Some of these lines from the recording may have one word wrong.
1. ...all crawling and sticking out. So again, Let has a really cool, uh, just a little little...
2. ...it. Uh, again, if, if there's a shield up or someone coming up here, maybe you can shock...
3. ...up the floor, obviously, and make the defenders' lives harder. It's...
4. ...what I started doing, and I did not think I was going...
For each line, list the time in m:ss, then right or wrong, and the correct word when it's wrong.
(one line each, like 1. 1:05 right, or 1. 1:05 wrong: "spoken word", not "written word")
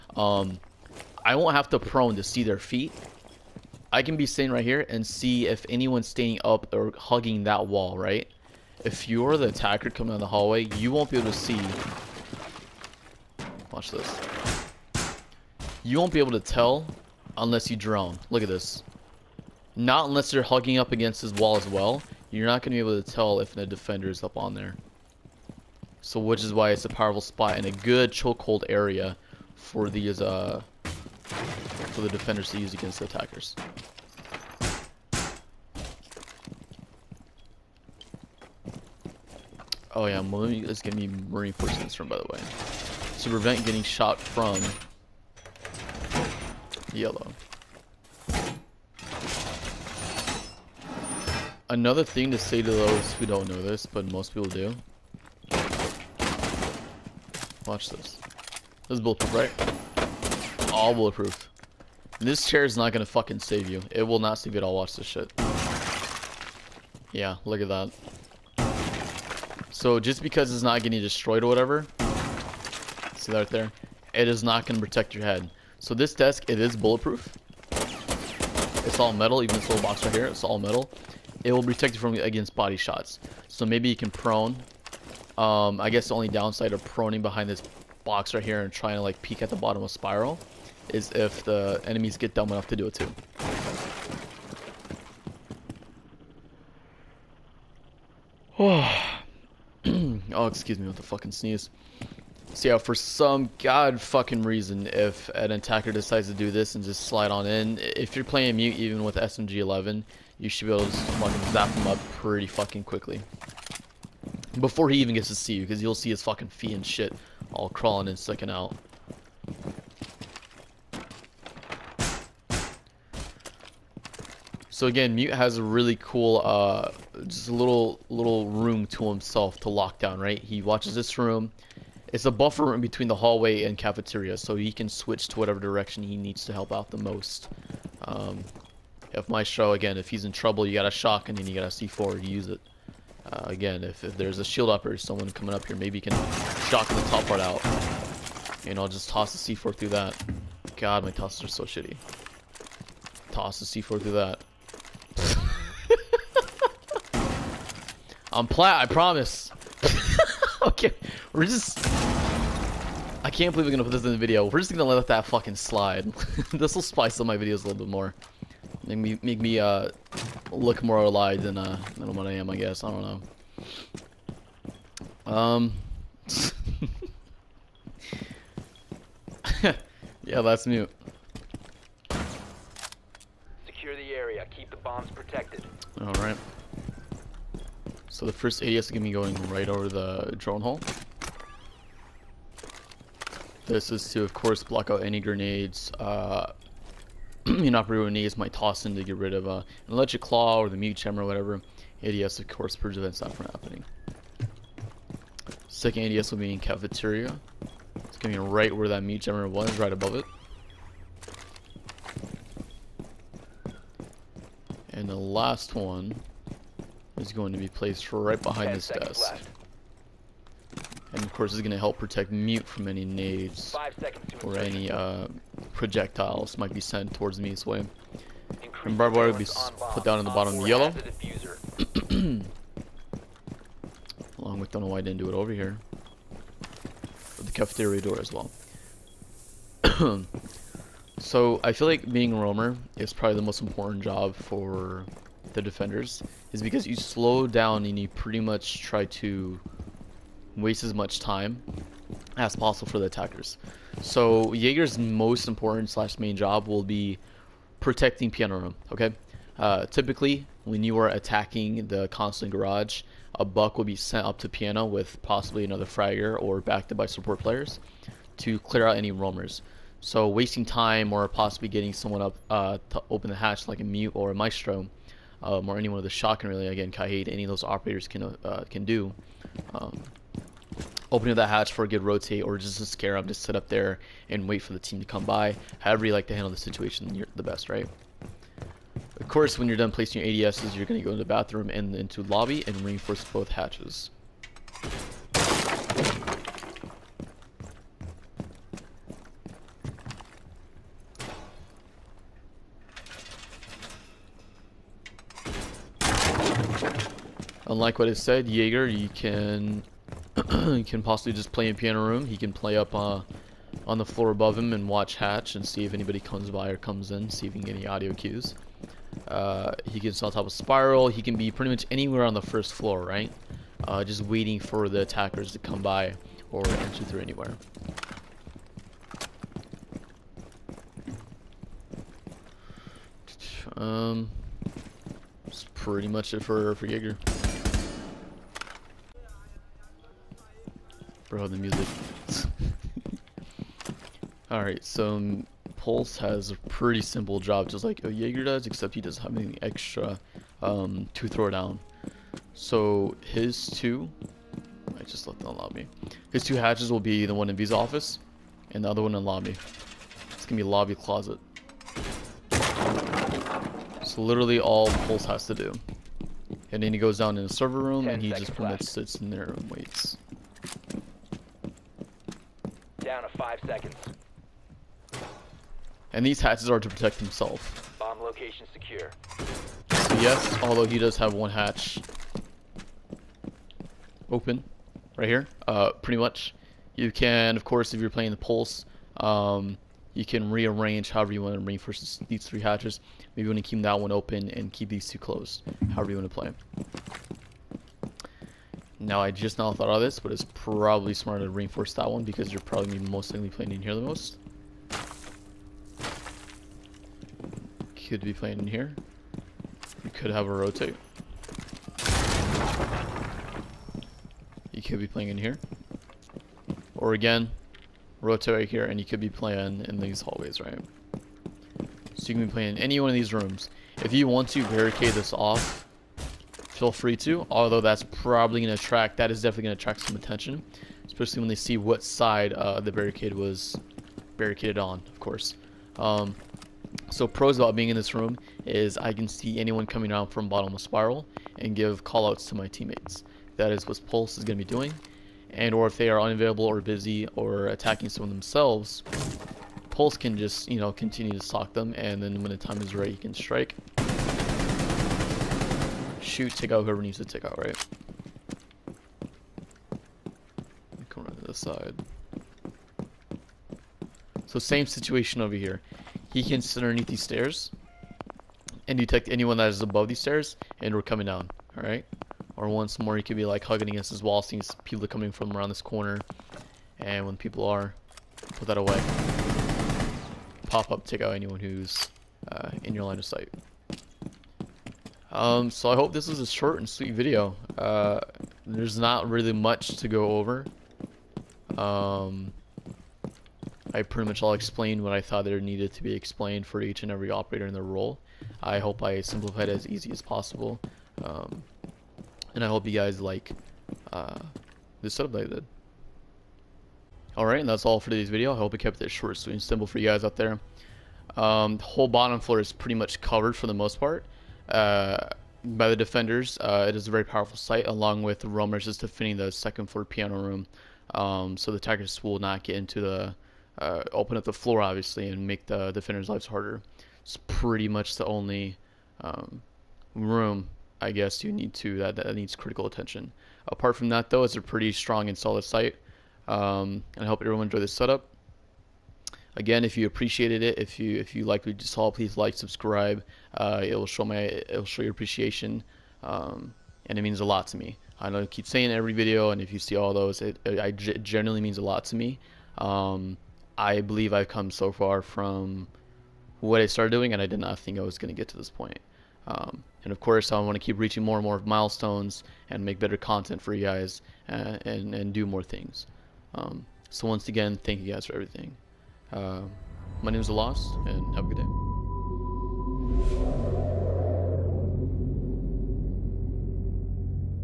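1. 1:57 wrong: "Mute", not "Let"
2. 2:22 right
3. 8:44 right
4. 9:16 right.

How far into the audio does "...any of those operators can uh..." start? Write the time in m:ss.
4:37.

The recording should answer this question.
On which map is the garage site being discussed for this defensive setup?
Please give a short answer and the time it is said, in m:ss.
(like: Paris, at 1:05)
Consulate, at 4:22.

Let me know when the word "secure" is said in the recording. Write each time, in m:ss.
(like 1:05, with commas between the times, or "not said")
3:03, 6:18.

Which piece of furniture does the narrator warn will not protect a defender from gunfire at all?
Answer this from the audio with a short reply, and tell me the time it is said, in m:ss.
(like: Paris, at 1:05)
chair, at 1:02.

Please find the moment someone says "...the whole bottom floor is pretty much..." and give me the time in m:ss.
8:31.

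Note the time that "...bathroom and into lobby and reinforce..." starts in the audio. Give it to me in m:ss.
4:51.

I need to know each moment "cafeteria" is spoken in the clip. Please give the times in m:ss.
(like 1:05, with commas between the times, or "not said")
2:13, 3:26, 3:57.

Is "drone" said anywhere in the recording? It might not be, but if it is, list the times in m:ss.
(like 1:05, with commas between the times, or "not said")
0:17, 3:10.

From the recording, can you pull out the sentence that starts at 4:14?
So Jaeger's most important slash main job will be protecting piano room, okay?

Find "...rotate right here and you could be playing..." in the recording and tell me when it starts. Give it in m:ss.
6:58.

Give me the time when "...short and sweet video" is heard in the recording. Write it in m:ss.
8:06.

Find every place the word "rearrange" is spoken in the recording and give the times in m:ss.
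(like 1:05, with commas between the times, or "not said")
6:30.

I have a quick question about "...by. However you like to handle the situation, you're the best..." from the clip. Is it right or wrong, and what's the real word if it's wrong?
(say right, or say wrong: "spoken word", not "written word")
right.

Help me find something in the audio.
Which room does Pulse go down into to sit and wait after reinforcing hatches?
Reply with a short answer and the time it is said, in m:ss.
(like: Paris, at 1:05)
server room, at 6:07.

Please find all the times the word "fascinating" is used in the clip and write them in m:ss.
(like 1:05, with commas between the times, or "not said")
not said.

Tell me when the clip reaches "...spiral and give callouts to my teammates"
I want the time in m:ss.
7:20.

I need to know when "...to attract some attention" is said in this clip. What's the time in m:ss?
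7:09.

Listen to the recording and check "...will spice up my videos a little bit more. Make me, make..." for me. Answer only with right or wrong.
right.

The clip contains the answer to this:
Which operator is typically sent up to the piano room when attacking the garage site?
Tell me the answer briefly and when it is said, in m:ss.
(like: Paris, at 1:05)
Buck, at 4:23.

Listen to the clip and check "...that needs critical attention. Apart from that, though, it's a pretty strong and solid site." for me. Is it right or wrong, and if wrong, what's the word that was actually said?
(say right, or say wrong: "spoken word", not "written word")
right.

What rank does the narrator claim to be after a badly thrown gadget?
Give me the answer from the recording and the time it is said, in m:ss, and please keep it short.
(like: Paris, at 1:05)
Plat, at 2:38.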